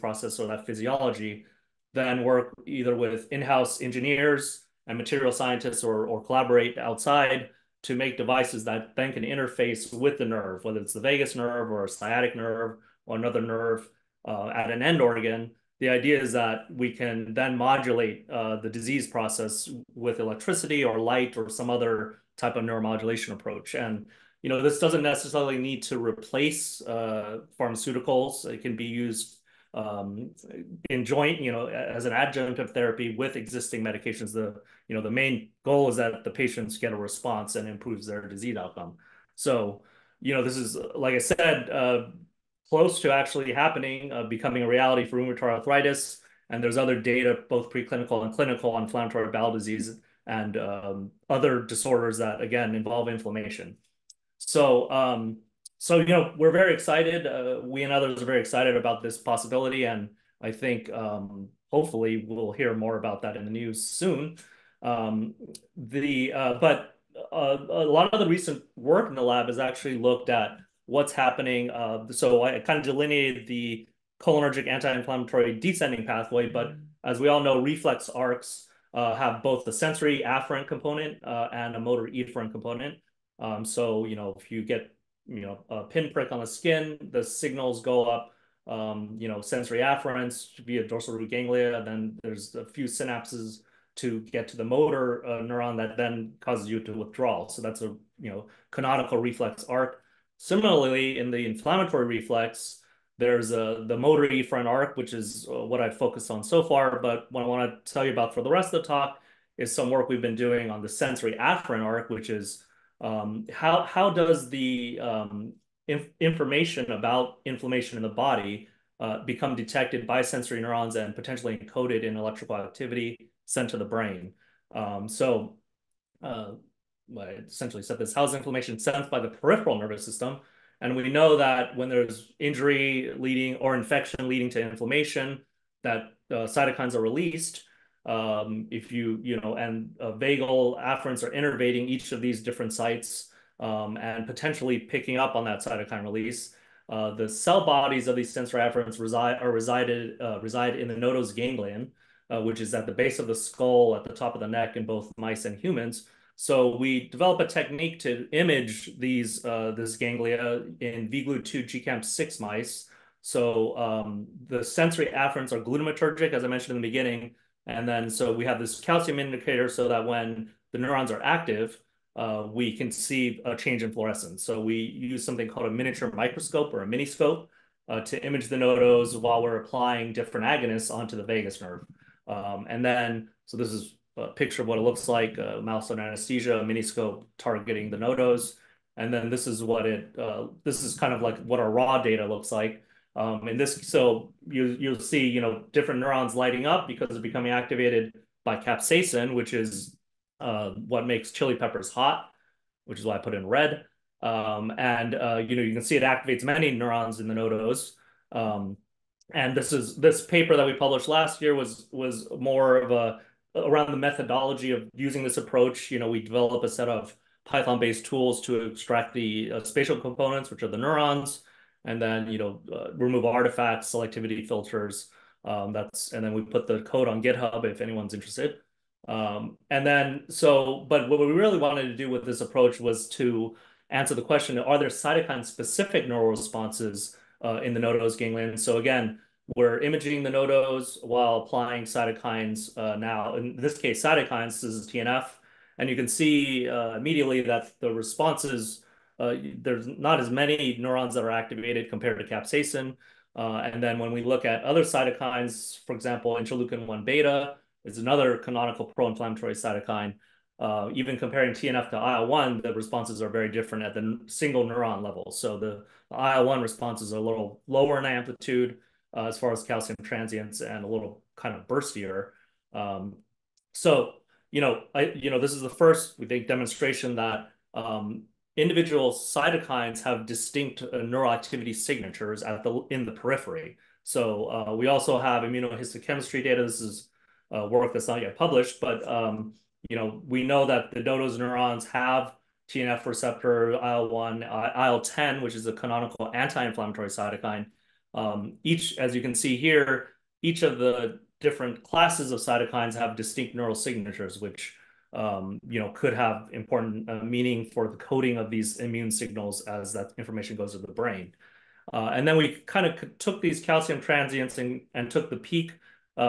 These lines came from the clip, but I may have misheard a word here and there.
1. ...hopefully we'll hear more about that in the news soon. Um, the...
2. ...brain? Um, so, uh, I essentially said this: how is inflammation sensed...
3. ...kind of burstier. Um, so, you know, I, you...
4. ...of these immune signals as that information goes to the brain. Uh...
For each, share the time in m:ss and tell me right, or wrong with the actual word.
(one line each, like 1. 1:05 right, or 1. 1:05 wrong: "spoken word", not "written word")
1. 1:01 right
2. 2:03 right
3. 4:31 right
4. 5:08 right.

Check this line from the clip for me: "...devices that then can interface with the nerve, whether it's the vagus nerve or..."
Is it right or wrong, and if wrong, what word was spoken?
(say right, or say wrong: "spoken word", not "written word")
right.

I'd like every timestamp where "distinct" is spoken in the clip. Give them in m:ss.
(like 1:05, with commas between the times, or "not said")
4:40, 5:03.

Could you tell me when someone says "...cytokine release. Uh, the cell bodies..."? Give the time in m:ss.
2:25.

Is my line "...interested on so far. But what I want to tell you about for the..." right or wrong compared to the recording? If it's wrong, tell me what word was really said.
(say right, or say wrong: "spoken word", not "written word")
wrong: "focused", not "interested".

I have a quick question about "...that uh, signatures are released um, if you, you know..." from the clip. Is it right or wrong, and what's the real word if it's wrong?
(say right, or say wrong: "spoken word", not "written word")
wrong: "cytokines", not "signatures".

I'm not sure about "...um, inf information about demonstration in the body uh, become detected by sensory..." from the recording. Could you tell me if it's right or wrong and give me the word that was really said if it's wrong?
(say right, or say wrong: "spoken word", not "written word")
wrong: "inflammation", not "demonstration".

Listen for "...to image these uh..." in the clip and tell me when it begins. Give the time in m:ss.
2:37.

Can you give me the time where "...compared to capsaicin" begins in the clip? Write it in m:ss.
4:11.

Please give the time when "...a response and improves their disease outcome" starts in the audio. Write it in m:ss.
0:36.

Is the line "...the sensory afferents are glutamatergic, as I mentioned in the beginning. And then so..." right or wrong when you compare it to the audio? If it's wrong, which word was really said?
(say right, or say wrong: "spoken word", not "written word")
right.